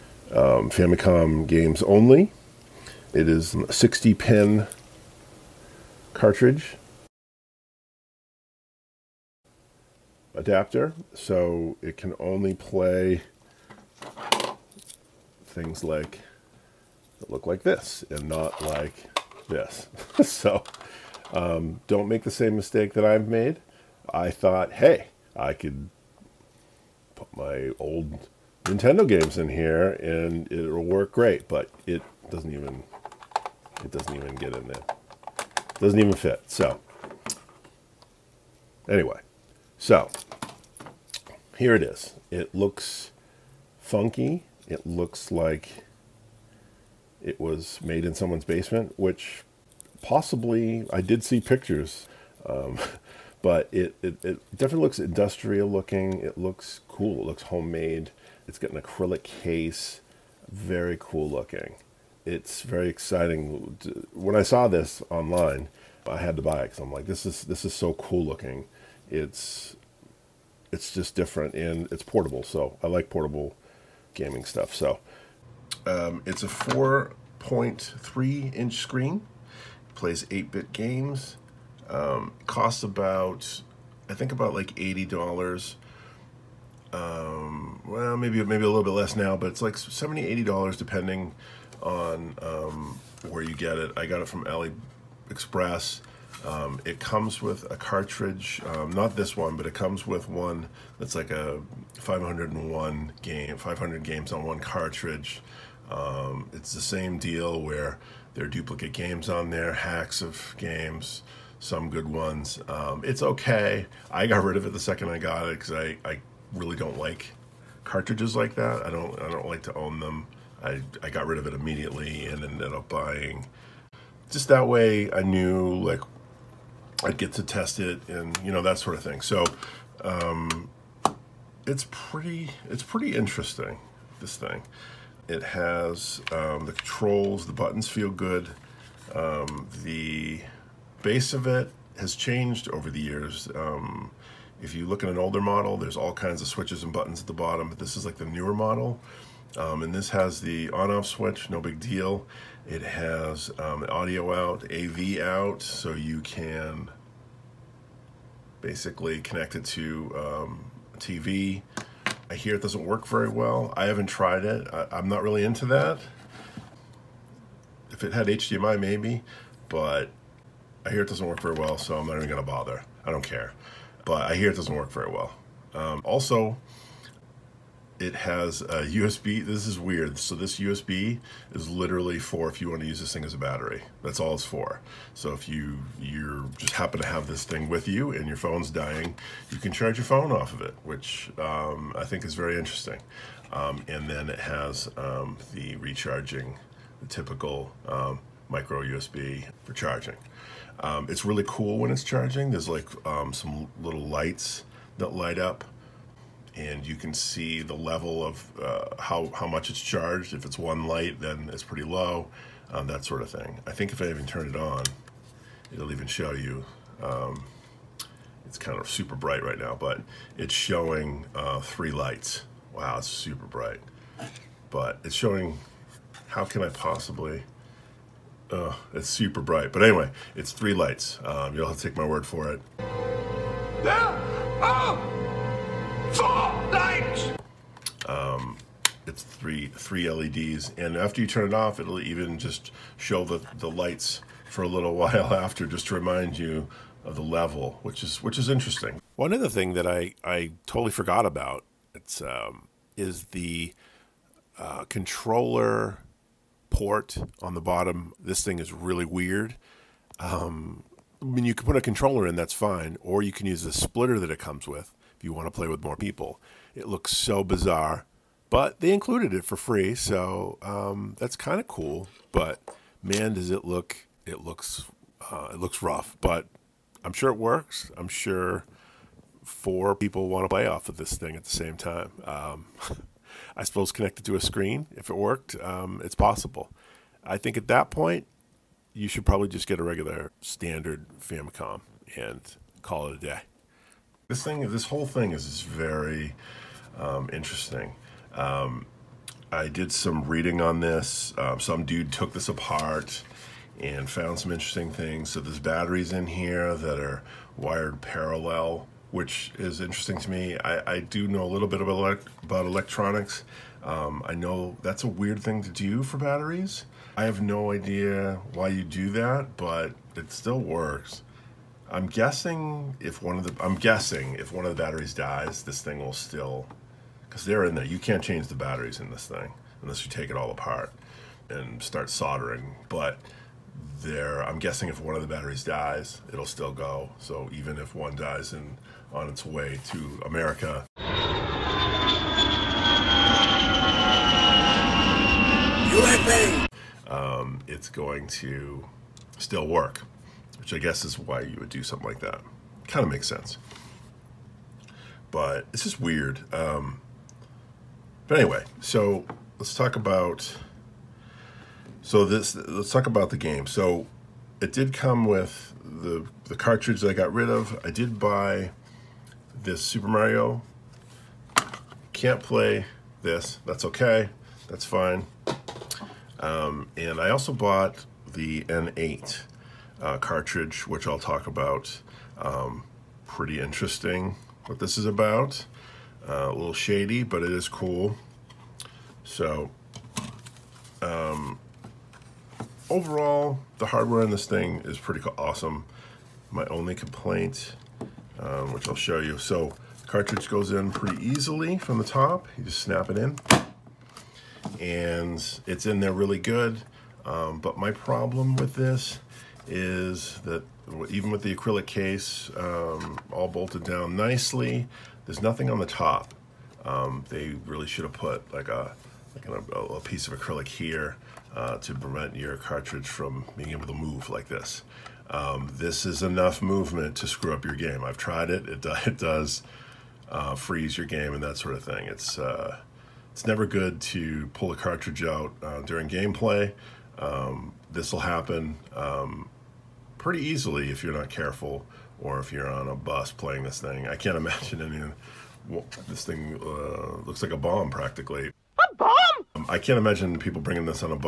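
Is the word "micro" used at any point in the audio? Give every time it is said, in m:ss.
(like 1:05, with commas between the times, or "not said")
3:18.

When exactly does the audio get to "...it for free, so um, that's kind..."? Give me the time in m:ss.
4:29.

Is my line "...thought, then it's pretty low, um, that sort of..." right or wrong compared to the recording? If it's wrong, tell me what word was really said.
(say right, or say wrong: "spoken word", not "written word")
wrong: "light", not "thought".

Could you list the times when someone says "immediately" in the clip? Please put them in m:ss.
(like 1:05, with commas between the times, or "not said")
2:01.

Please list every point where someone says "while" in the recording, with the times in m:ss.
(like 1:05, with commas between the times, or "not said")
4:04.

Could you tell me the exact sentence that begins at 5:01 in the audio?
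Um, some dude took this apart and found some interesting things.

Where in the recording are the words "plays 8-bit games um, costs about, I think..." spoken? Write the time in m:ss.
1:19.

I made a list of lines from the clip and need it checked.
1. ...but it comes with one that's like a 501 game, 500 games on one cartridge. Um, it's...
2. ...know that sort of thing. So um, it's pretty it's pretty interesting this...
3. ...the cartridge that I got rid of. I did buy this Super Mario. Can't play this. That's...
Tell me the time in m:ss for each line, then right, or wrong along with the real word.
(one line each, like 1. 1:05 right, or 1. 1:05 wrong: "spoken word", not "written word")
1. 1:39 right
2. 2:08 right
3. 6:06 right.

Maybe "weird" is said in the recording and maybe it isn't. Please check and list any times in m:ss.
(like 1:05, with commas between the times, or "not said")
2:59, 4:19, 5:15, 5:55.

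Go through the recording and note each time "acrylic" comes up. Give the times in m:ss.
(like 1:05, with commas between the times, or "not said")
0:58, 6:51, 7:00.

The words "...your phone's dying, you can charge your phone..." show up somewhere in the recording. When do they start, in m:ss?
3:08.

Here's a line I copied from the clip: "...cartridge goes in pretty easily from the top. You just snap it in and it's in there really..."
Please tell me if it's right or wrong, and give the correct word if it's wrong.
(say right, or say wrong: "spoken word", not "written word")
right.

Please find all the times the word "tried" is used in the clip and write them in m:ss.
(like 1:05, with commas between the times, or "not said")
2:44, 7:08.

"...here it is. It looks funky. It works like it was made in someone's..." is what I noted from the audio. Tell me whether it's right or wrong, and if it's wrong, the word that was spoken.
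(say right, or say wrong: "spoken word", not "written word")
wrong: "looks", not "works".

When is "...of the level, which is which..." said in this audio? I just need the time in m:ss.
4:07.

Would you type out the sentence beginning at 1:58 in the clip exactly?
I don't I don't like to own them.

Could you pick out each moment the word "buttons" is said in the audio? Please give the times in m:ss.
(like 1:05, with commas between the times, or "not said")
2:17, 2:26.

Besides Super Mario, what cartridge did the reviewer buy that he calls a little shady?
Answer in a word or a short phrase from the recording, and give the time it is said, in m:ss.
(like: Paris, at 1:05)
N8, at 6:18.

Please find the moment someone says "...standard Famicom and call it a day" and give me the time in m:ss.
4:50.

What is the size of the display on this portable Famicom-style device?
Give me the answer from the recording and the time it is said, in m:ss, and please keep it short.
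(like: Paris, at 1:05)
4.3 inch, at 1:16.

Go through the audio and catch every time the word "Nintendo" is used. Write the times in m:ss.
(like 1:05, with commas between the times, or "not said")
0:28.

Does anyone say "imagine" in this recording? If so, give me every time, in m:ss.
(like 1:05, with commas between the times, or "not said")
7:24, 7:29.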